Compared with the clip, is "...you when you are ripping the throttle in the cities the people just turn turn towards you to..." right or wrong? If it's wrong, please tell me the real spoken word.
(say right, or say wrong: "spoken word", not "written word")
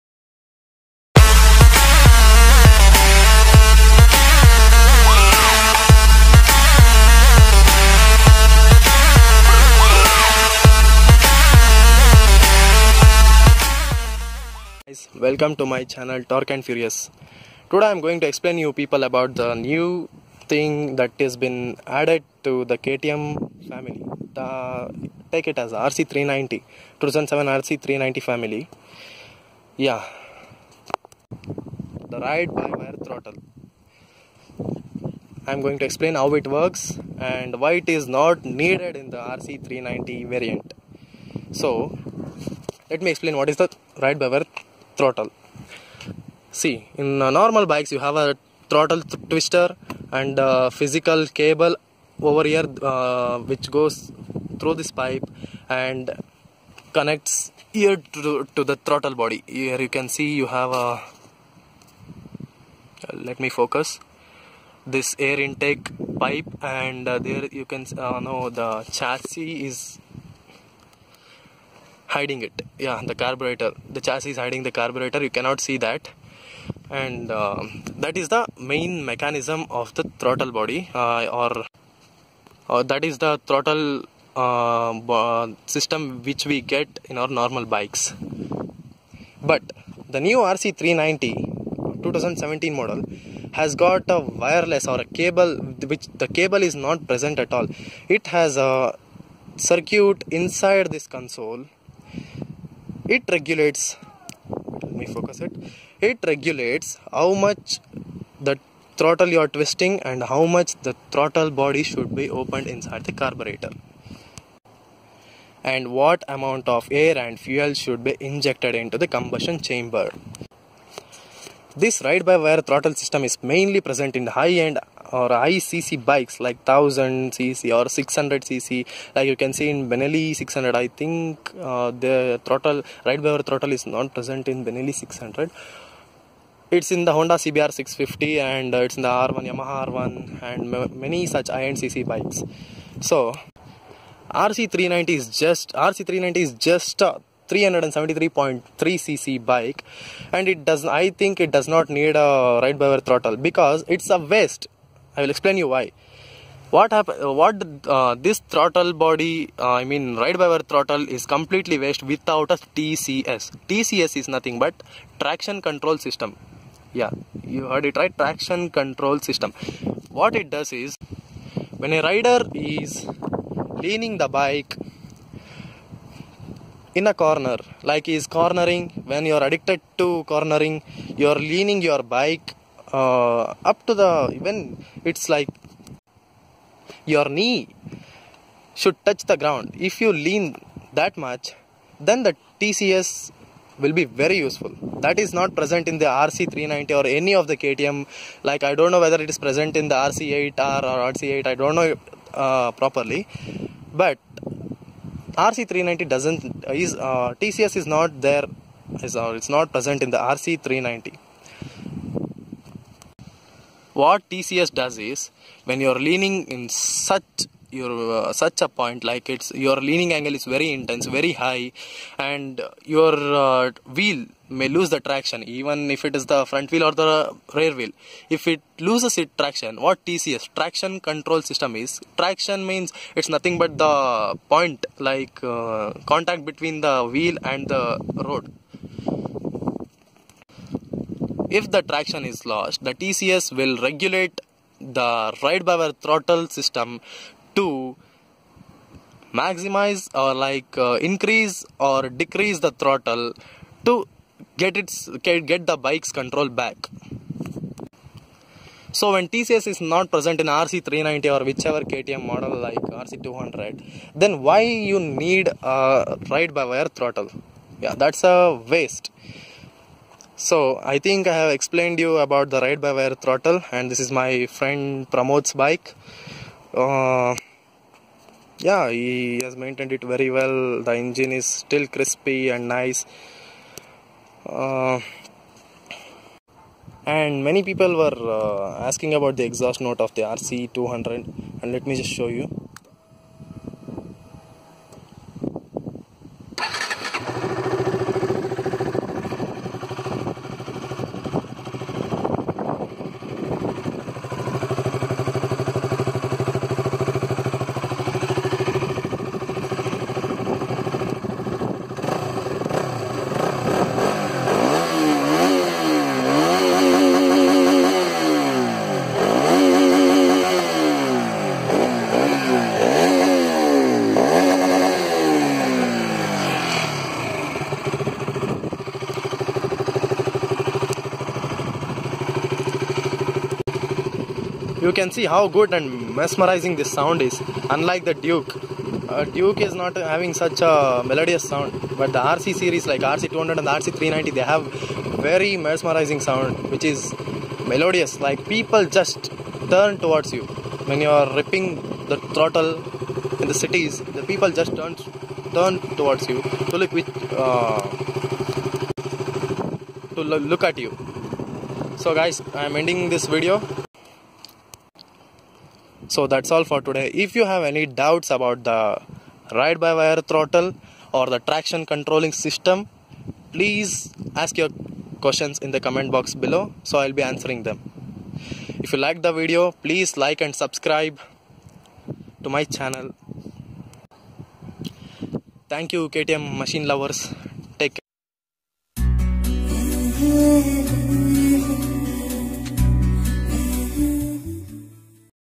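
right.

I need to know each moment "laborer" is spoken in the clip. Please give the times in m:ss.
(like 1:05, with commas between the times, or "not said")
not said.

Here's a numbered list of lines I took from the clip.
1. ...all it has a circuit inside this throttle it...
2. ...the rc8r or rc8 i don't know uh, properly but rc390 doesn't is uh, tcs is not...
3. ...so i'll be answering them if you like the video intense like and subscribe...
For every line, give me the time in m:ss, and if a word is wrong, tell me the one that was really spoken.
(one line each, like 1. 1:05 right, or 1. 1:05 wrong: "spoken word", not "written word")
1. 1:37 wrong: "console", not "throttle"
2. 3:19 right
3. 6:16 wrong: "please", not "intense".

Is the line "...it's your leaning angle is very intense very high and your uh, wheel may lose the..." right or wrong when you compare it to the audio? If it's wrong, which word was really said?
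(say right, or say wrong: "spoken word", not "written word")
right.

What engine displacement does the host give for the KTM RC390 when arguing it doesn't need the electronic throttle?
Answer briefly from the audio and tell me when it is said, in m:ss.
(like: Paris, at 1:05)
373.3 cc, at 2:26.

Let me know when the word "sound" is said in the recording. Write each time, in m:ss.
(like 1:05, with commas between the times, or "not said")
5:36, 5:41, 5:46.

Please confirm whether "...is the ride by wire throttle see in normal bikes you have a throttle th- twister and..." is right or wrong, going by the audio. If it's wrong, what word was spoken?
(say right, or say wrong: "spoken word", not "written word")
right.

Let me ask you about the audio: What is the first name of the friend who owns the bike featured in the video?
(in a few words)
Pramod.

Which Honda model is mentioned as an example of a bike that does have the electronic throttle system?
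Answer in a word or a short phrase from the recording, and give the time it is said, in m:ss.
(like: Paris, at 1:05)
CBR 650, at 2:17.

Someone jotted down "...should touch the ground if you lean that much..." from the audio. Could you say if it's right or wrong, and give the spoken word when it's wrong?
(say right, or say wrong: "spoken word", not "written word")
right.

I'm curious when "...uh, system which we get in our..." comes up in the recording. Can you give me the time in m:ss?
1:24.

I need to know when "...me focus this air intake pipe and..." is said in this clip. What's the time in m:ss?
1:03.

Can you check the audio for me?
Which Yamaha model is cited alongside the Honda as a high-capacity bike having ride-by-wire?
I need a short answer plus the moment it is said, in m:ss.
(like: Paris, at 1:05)
Yamaha R1, at 2:19.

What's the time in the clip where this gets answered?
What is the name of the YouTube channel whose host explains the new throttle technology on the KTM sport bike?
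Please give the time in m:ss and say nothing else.
0:16.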